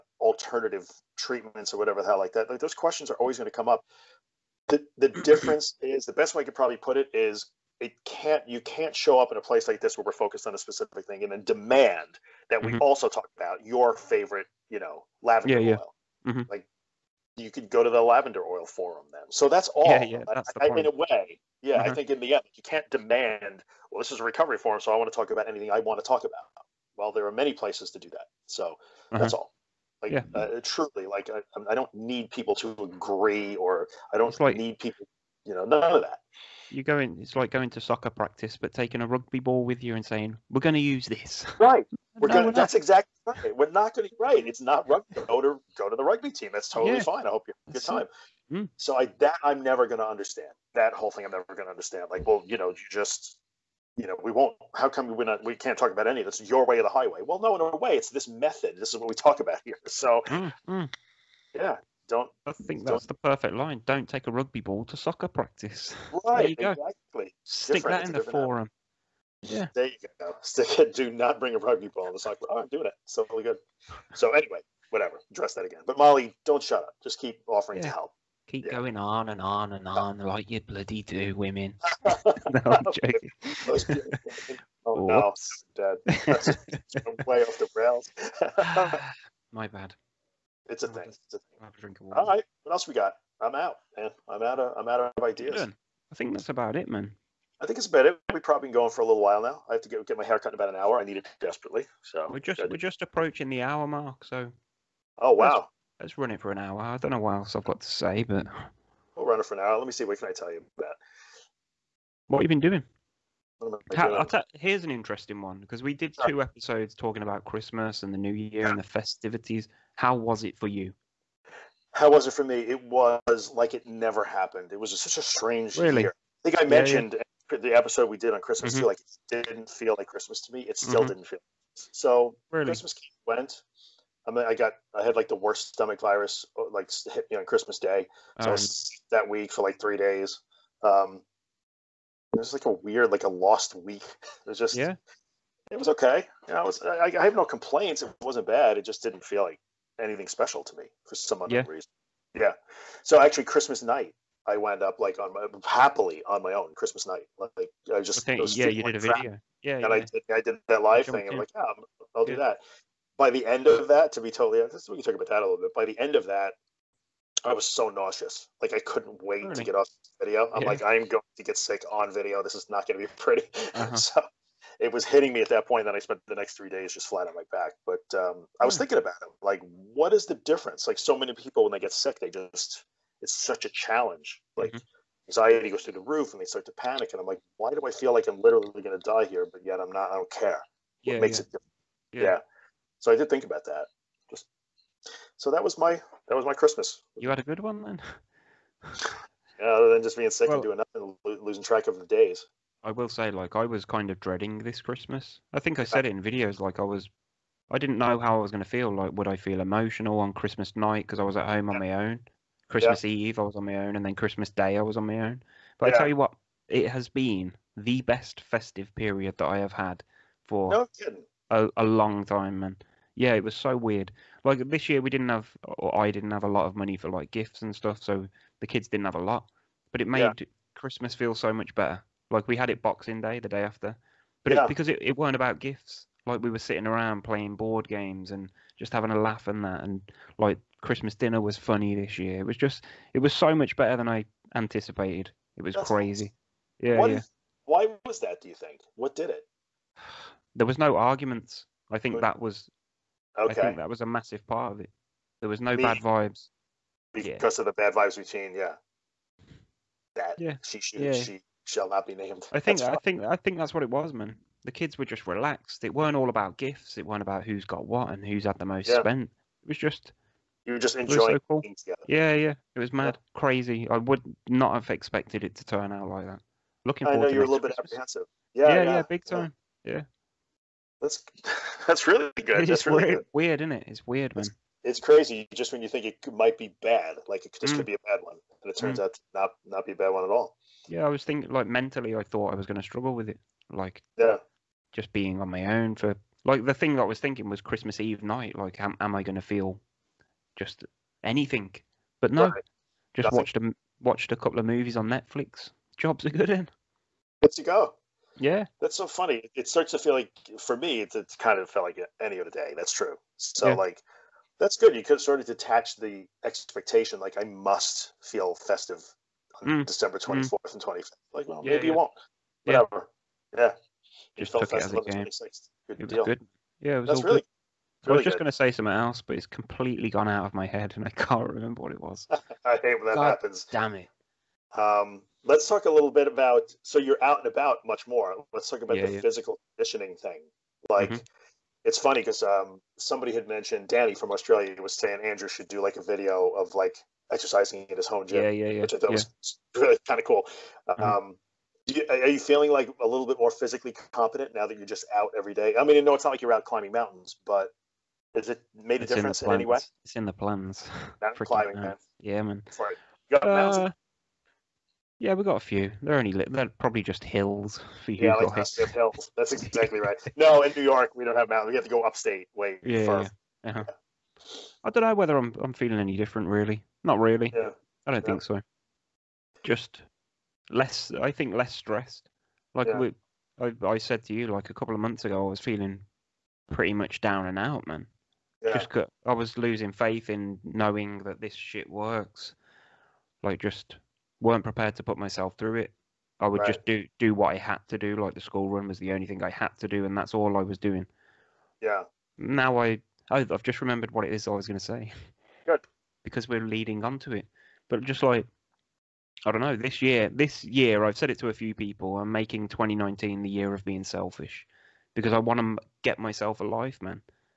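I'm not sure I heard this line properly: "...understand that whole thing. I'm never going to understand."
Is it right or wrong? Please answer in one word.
right.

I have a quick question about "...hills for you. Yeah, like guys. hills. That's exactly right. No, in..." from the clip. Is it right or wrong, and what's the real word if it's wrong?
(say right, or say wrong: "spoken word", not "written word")
right.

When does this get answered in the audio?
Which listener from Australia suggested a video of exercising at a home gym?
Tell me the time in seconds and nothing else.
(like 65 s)
343 s.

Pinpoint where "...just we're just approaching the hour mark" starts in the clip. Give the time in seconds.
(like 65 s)
102 s.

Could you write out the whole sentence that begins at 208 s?
Like, would I feel emotional on Christmas night because I was at home on my own?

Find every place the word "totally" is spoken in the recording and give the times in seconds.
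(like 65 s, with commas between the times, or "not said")
46 s, 164 s.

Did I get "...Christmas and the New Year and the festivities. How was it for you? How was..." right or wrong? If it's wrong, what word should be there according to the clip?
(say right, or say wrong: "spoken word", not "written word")
right.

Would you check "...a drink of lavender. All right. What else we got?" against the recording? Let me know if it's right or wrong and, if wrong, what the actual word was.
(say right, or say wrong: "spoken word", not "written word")
wrong: "water", not "lavender".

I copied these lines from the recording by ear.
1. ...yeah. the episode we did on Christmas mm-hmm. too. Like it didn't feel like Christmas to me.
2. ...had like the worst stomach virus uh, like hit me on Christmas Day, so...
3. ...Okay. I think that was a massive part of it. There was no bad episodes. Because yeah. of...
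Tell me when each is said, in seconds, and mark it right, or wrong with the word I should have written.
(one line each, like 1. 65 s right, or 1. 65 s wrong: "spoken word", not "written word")
1. 127 s right
2. 135 s right
3. 253 s wrong: "vibes", not "episodes".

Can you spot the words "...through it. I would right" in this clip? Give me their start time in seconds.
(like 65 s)
395 s.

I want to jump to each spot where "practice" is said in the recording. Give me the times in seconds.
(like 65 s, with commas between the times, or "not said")
38 s, 65 s.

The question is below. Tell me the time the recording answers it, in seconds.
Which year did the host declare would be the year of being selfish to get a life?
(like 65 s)
412 s.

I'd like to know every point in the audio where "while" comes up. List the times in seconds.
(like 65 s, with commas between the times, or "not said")
99 s.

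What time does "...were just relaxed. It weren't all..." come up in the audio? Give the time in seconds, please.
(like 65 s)
264 s.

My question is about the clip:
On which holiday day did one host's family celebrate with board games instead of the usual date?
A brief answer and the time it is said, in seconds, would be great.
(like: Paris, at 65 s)
Boxing Day, at 232 s.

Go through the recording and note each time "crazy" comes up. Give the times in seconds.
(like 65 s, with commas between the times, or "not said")
245 s, 273 s, 285 s.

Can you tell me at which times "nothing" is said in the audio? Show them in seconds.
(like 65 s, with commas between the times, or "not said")
200 s, 303 s.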